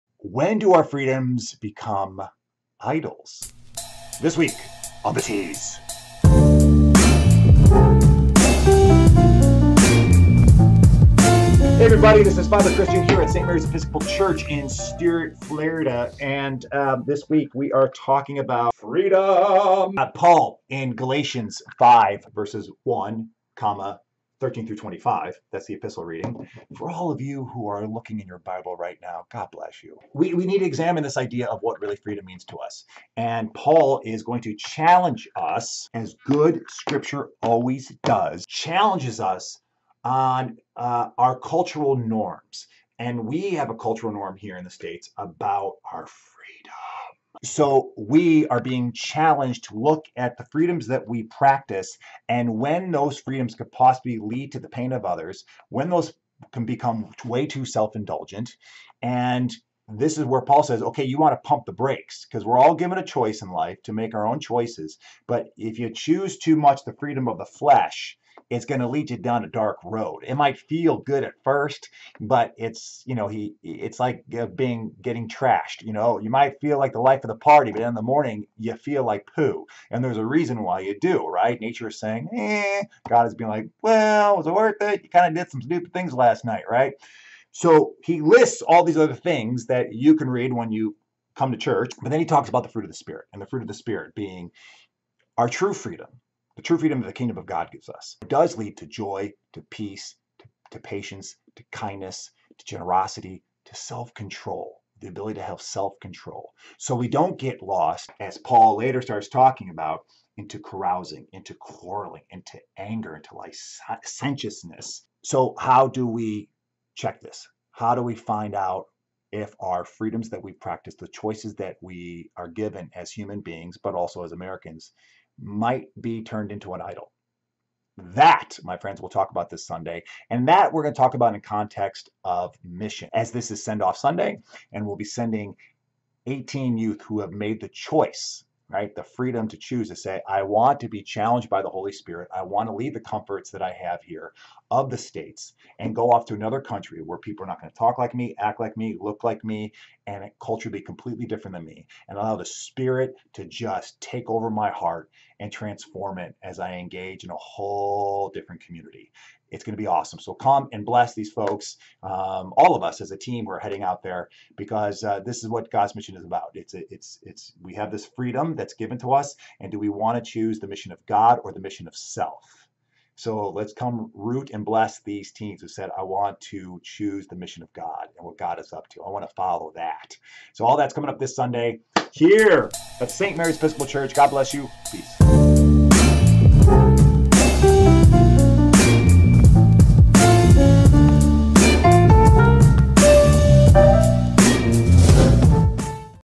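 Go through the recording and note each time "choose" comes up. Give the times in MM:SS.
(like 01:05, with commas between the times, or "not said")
01:05, 02:19, 02:50, 02:56.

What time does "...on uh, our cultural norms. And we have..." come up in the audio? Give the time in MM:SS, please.
00:40.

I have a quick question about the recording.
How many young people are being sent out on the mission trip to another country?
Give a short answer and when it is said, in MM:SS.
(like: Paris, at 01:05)
18, at 02:16.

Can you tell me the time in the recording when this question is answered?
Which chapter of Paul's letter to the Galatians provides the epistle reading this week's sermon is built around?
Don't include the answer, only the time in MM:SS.
00:20.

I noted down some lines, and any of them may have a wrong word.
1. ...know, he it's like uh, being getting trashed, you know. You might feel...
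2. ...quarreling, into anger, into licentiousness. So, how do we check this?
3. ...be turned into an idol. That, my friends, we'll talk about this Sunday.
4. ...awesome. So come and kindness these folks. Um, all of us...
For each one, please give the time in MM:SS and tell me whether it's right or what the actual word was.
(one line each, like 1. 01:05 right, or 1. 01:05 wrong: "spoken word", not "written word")
1. 01:13 right
2. 01:51 right
3. 02:06 right
4. 02:39 wrong: "bless", not "kindness".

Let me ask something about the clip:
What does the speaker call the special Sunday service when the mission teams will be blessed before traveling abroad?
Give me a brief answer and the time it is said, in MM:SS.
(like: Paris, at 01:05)
Send Off Sunday, at 02:13.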